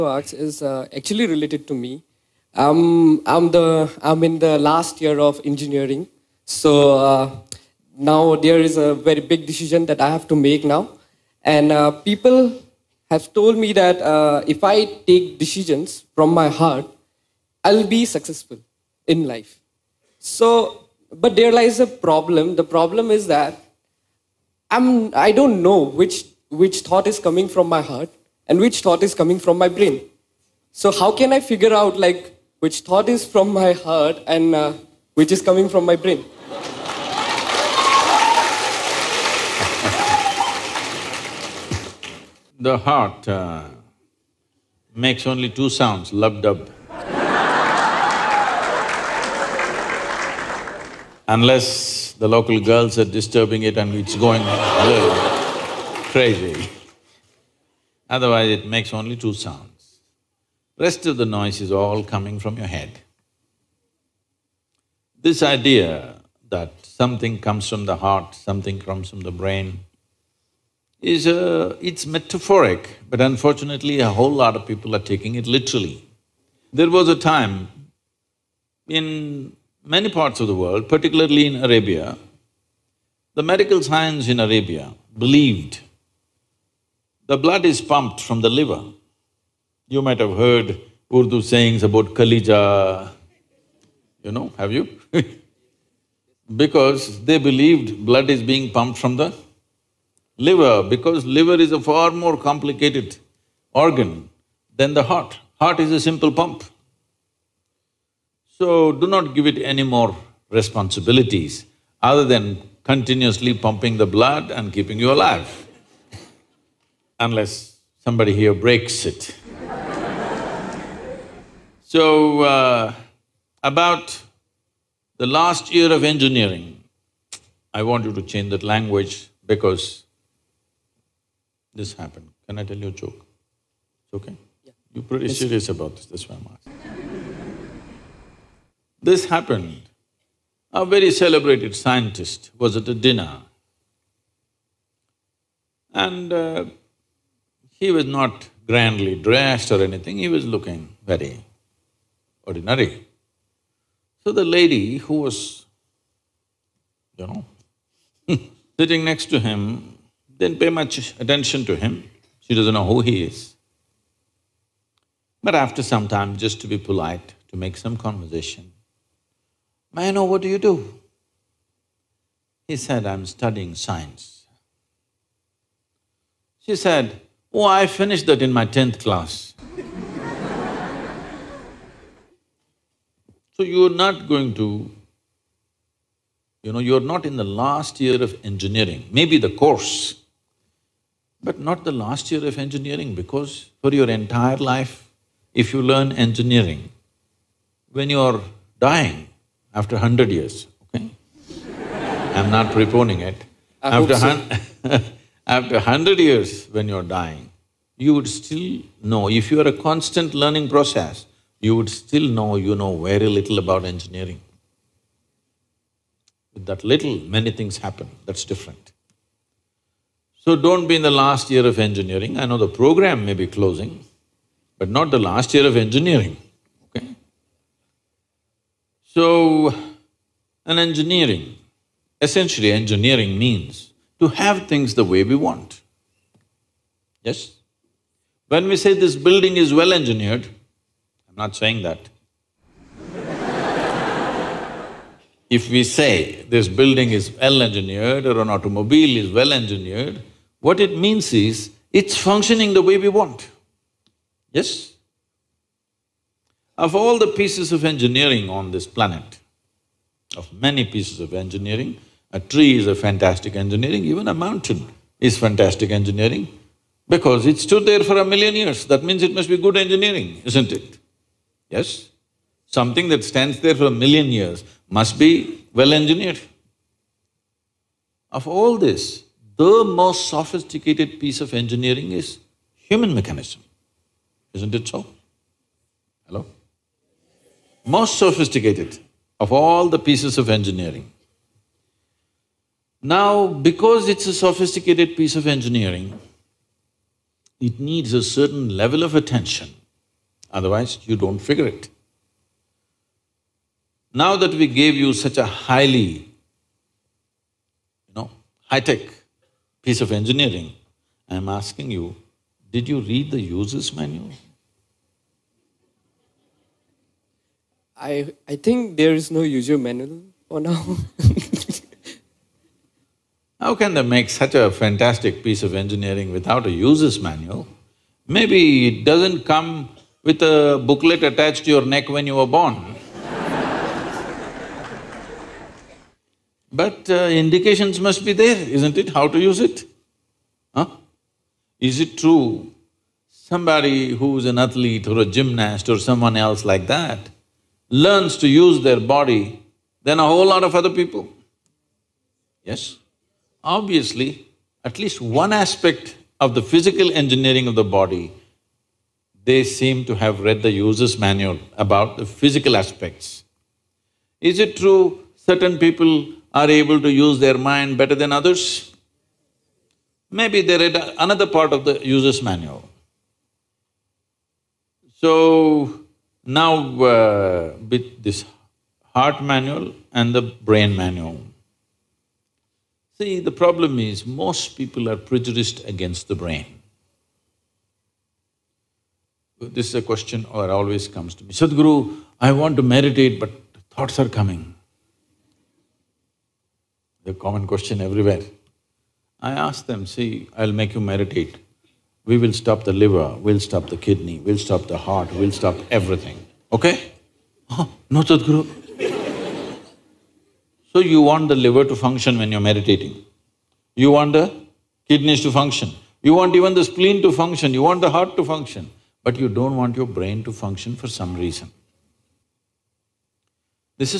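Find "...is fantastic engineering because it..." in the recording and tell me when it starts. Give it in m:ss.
4:25.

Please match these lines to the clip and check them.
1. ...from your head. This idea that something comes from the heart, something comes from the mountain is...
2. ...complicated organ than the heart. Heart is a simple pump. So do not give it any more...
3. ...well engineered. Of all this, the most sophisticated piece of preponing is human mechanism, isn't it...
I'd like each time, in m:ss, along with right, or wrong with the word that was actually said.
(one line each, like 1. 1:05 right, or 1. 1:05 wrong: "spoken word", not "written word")
1. 1:02 wrong: "brain", not "mountain"
2. 1:42 right
3. 4:35 wrong: "engineering", not "preponing".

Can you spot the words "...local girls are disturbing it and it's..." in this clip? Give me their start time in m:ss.
0:52.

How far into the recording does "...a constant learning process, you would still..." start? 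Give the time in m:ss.
3:29.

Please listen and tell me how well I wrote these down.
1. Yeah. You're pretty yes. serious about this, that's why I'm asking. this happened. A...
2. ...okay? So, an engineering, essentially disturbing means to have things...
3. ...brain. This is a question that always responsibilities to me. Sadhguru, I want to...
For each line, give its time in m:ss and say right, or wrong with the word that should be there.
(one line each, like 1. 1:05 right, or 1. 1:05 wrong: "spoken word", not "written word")
1. 2:14 right
2. 3:46 wrong: "engineering", not "disturbing"
3. 6:26 wrong: "comes", not "responsibilities".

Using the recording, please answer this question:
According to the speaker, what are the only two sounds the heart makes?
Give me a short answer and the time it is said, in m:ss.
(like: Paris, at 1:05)
lub-dub, at 0:46.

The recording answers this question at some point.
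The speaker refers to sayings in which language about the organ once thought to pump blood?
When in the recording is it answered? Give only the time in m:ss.
1:31.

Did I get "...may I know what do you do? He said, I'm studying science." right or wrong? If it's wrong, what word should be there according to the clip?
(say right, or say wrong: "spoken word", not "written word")
right.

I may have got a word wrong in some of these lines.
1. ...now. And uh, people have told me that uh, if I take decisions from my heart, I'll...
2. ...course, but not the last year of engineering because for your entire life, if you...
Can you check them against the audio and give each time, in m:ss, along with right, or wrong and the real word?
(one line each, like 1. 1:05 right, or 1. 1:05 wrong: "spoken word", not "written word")
1. 0:10 right
2. 3:09 right.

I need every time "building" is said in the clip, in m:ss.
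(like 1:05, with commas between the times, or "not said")
3:59, 4:06.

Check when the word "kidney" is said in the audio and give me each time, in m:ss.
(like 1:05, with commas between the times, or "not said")
6:43, 6:55.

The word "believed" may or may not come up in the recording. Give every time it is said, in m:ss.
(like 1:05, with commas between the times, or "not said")
1:25, 1:37.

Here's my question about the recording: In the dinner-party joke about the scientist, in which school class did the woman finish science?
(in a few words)
tenth class.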